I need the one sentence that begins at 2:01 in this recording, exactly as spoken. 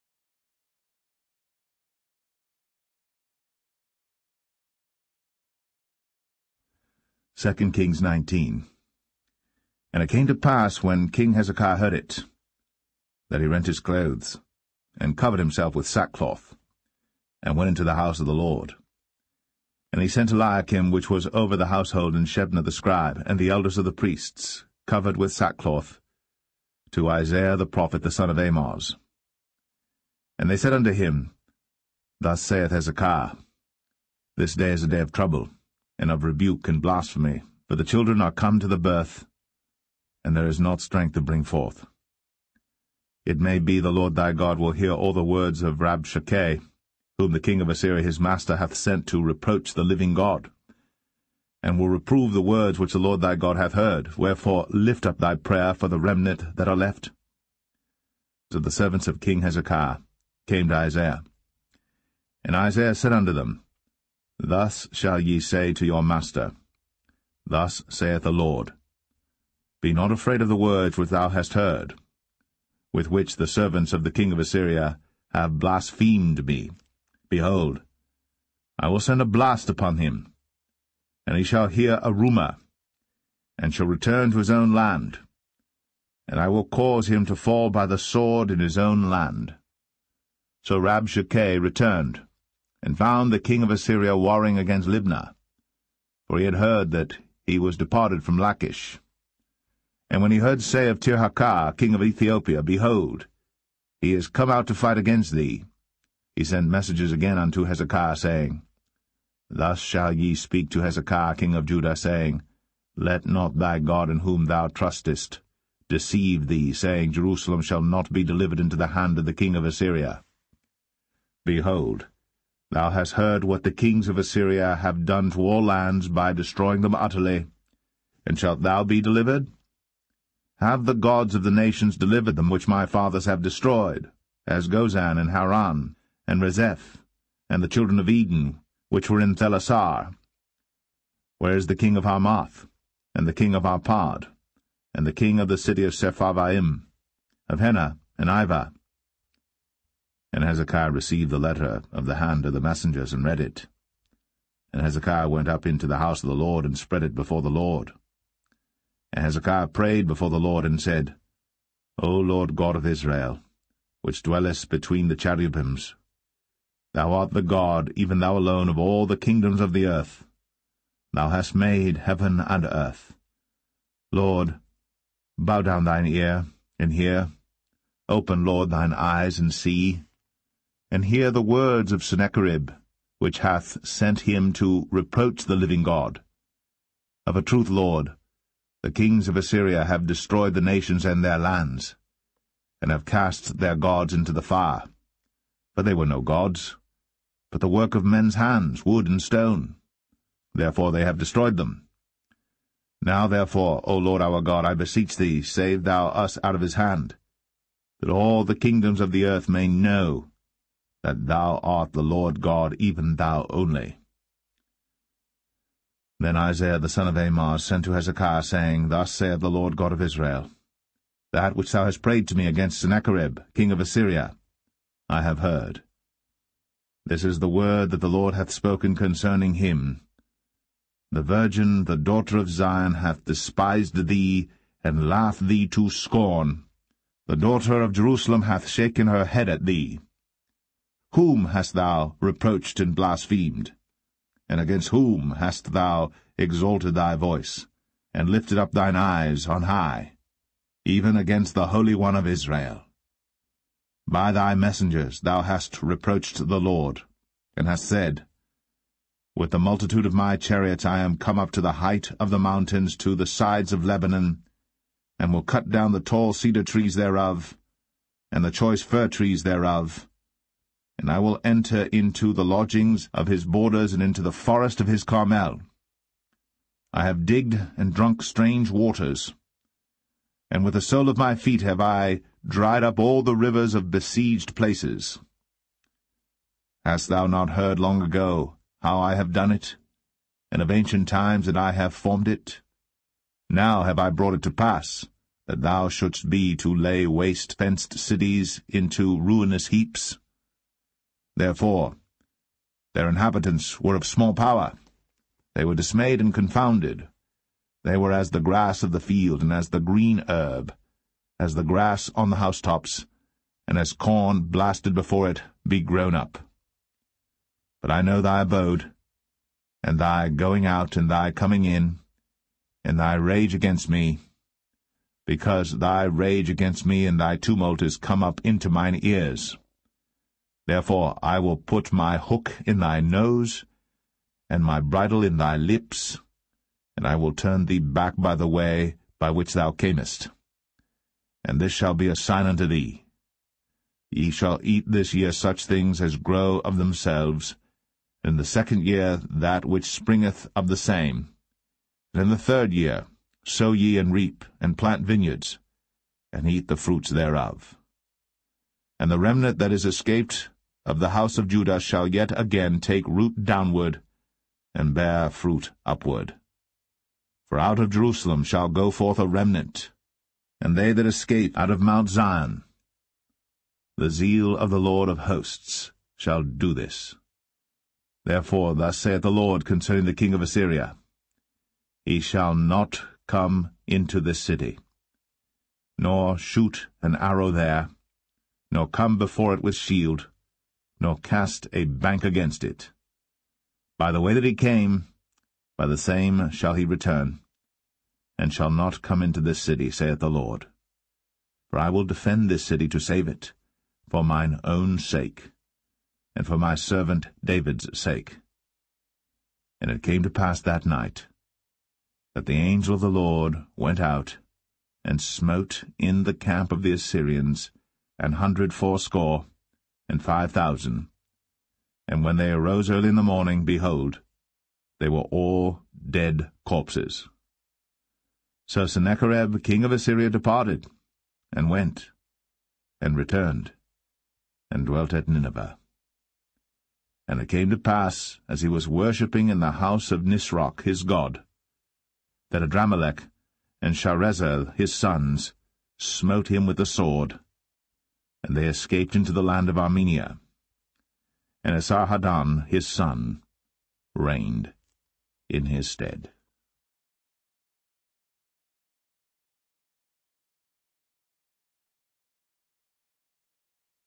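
Behold, Thou hast heard what the kings of Assyria have done to all lands by destroying them utterly.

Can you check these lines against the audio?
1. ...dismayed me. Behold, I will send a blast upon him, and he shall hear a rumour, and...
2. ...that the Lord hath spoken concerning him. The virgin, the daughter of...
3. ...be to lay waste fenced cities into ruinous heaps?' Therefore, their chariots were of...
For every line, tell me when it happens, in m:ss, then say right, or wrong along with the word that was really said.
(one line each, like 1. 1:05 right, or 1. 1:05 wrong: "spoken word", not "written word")
1. 1:15 wrong: "blasphemed", not "dismayed"
2. 3:47 right
3. 4:56 wrong: "inhabitants", not "chariots".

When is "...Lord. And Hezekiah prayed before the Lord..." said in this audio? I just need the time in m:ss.
2:37.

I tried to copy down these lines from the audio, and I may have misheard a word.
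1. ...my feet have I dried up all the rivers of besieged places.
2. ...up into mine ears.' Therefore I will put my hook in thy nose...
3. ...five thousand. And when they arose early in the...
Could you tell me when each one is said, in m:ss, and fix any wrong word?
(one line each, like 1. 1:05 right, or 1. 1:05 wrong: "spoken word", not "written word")
1. 4:41 right
2. 5:28 right
3. 7:00 right.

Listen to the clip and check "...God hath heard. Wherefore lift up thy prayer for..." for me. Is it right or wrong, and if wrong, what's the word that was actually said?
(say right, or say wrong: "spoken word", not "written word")
right.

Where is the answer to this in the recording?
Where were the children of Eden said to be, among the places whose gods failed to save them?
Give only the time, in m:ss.
2:19.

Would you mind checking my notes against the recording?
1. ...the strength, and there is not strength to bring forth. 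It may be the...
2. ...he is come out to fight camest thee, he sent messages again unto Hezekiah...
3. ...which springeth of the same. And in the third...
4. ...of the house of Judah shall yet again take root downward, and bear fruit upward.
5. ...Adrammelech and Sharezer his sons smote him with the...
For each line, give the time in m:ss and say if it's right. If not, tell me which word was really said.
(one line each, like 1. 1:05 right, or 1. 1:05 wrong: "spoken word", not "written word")
1. 0:38 wrong: "birth", not "strength"
2. 1:44 wrong: "against", not "camest"
3. 5:49 right
4. 6:00 right
5. 7:22 right.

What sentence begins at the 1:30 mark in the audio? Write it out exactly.
So Rabshakeh returned, and found the king of Assyria warring against Libnah, for he had heard that he was departed from Lachish.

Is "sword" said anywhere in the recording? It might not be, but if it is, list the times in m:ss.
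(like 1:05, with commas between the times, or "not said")
1:27, 7:26.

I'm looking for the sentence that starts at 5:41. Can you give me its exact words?
And this shall be a sign unto thee.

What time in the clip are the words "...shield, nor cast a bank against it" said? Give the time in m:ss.
6:29.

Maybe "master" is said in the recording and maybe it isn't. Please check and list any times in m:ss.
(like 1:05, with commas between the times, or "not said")
0:48, 1:06.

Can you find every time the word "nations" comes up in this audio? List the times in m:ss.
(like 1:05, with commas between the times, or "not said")
2:11, 3:10.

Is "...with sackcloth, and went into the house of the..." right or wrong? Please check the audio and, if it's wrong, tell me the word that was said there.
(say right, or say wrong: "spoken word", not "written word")
right.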